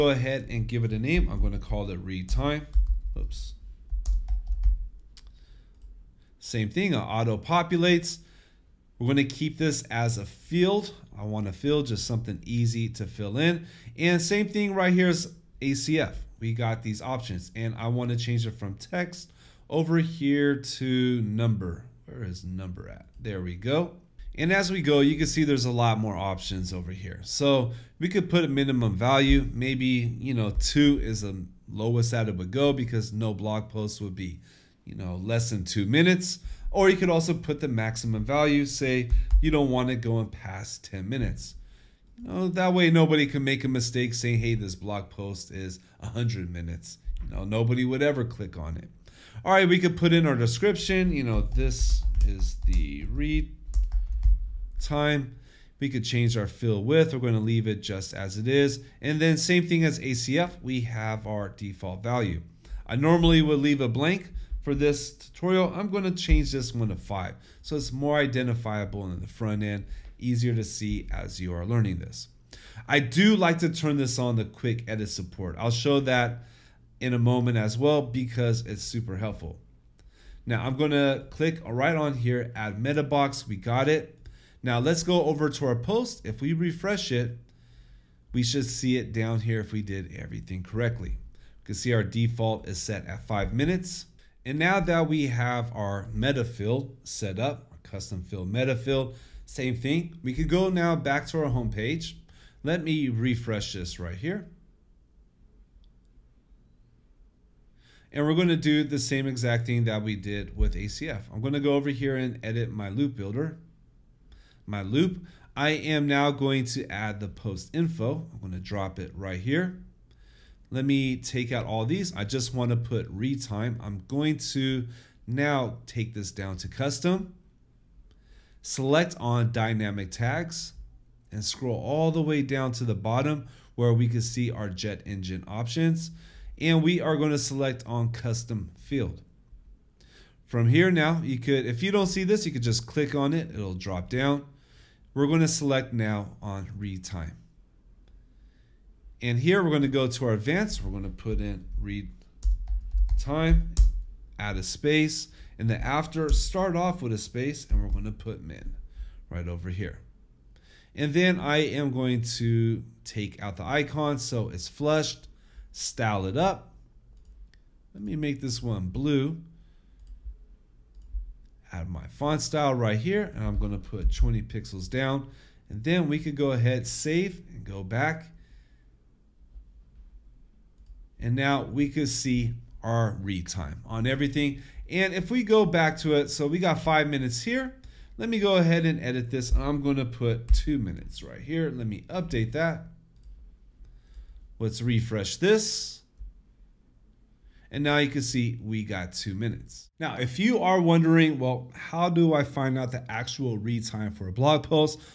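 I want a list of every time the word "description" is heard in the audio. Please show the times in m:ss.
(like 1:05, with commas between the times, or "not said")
0:50.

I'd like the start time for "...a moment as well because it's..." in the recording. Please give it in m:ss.
1:17.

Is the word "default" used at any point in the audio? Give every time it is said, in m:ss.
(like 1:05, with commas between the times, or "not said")
1:01, 1:32.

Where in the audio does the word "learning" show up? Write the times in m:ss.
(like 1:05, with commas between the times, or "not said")
1:11.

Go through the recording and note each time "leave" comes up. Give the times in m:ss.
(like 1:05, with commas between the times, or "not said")
0:57, 1:03.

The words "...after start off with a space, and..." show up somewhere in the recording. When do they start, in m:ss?
2:35.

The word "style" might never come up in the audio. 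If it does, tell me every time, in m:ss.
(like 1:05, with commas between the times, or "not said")
2:45, 2:52.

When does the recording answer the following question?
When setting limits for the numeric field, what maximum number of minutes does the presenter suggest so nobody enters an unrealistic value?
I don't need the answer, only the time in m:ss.
0:40.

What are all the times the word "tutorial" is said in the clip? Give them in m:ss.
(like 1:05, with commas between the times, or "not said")
1:05.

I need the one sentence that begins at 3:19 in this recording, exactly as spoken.
Now, if you are wondering, well, how do I find out the actual read time for a blog post?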